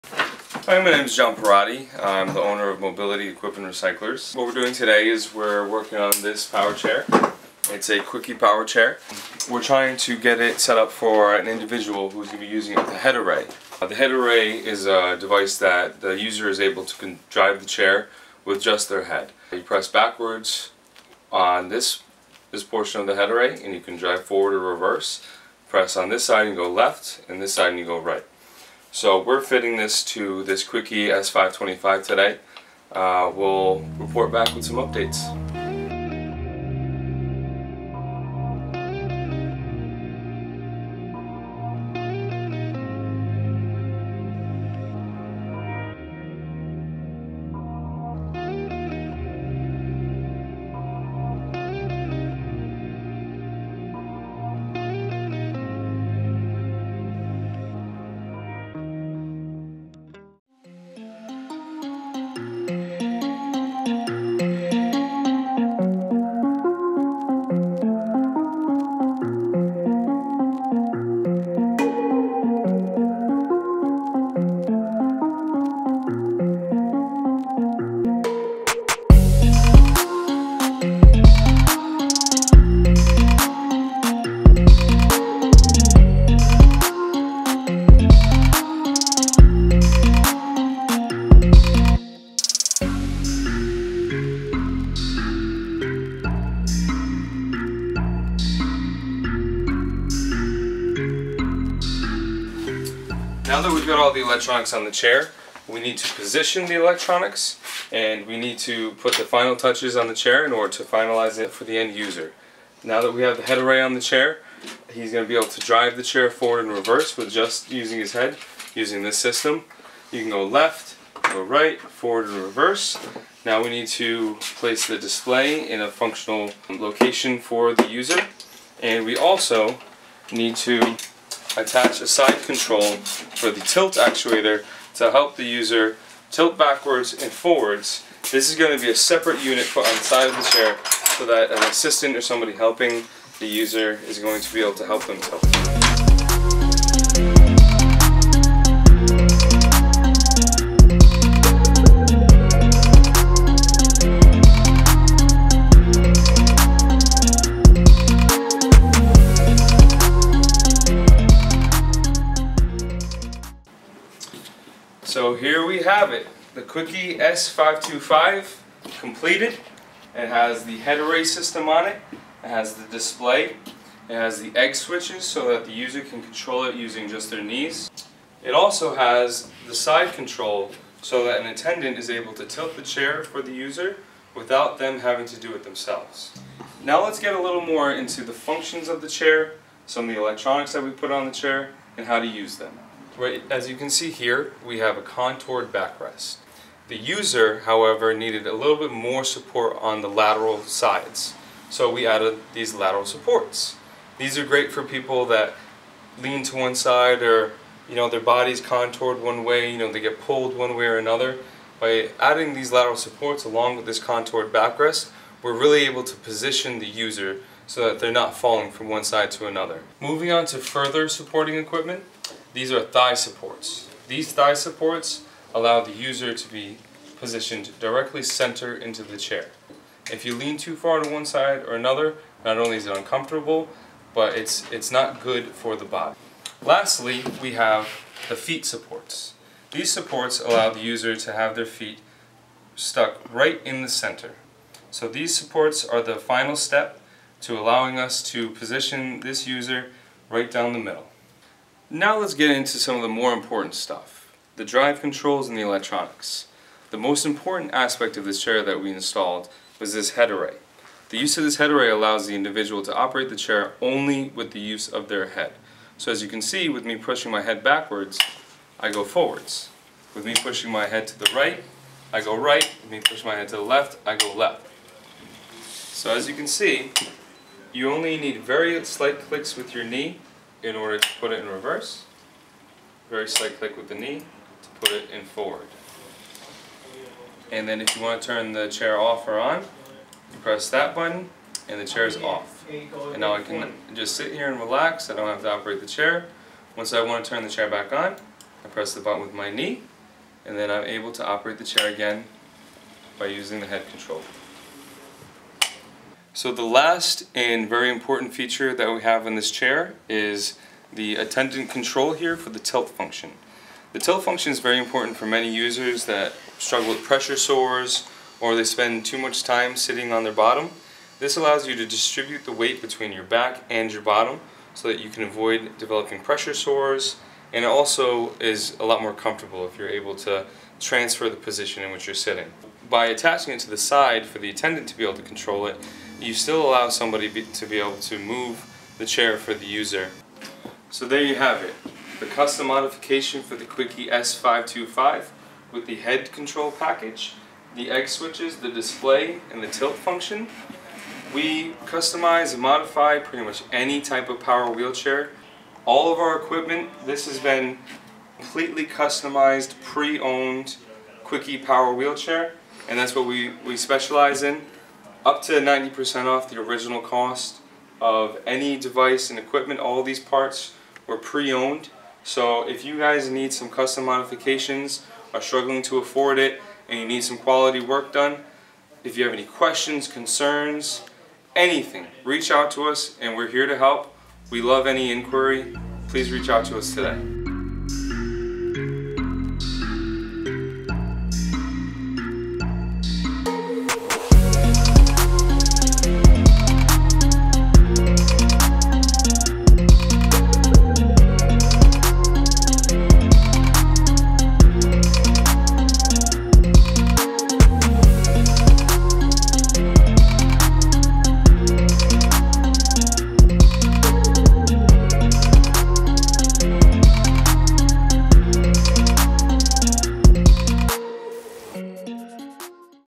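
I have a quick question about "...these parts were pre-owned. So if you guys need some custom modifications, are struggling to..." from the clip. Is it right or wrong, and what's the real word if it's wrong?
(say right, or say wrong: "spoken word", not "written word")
right.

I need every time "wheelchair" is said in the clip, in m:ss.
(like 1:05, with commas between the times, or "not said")
5:54, 6:01.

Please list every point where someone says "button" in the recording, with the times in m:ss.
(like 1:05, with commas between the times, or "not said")
4:50, 4:59.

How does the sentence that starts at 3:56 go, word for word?
Lastly, we have the feet supports.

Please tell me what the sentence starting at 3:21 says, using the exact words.
So we added these lateral supports.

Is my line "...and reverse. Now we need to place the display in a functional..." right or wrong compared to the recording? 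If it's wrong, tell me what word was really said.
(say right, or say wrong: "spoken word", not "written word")
right.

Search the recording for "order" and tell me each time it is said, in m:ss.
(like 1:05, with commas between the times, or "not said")
1:50, 4:40.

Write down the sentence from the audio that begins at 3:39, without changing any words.
Moving on to further supporting equipment, these are thigh supports.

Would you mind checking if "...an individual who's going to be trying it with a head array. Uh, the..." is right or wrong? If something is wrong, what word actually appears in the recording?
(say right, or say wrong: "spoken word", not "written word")
wrong: "using", not "trying".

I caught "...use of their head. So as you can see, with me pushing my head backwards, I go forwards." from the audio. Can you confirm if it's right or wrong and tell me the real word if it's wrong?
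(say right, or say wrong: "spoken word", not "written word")
right.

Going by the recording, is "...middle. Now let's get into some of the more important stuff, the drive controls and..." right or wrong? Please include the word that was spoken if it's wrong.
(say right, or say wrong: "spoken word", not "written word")
right.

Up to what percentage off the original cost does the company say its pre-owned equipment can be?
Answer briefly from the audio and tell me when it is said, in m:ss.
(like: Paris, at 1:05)
90%, at 6:05.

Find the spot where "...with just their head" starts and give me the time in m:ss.
0:18.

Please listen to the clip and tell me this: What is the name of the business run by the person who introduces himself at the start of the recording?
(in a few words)
Mobility Equipment Recyclers.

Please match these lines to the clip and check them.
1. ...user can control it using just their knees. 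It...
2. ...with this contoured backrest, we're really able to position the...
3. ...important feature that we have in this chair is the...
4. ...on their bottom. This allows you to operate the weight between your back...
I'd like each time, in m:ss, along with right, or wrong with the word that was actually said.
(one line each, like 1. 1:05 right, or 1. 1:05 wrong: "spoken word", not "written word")
1. 2:55 right
2. 3:33 right
3. 5:07 right
4. 5:20 wrong: "distribute", not "operate".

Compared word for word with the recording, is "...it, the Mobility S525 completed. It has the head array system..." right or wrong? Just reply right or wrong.
wrong.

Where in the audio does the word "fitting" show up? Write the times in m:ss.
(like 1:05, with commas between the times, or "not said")
0:29.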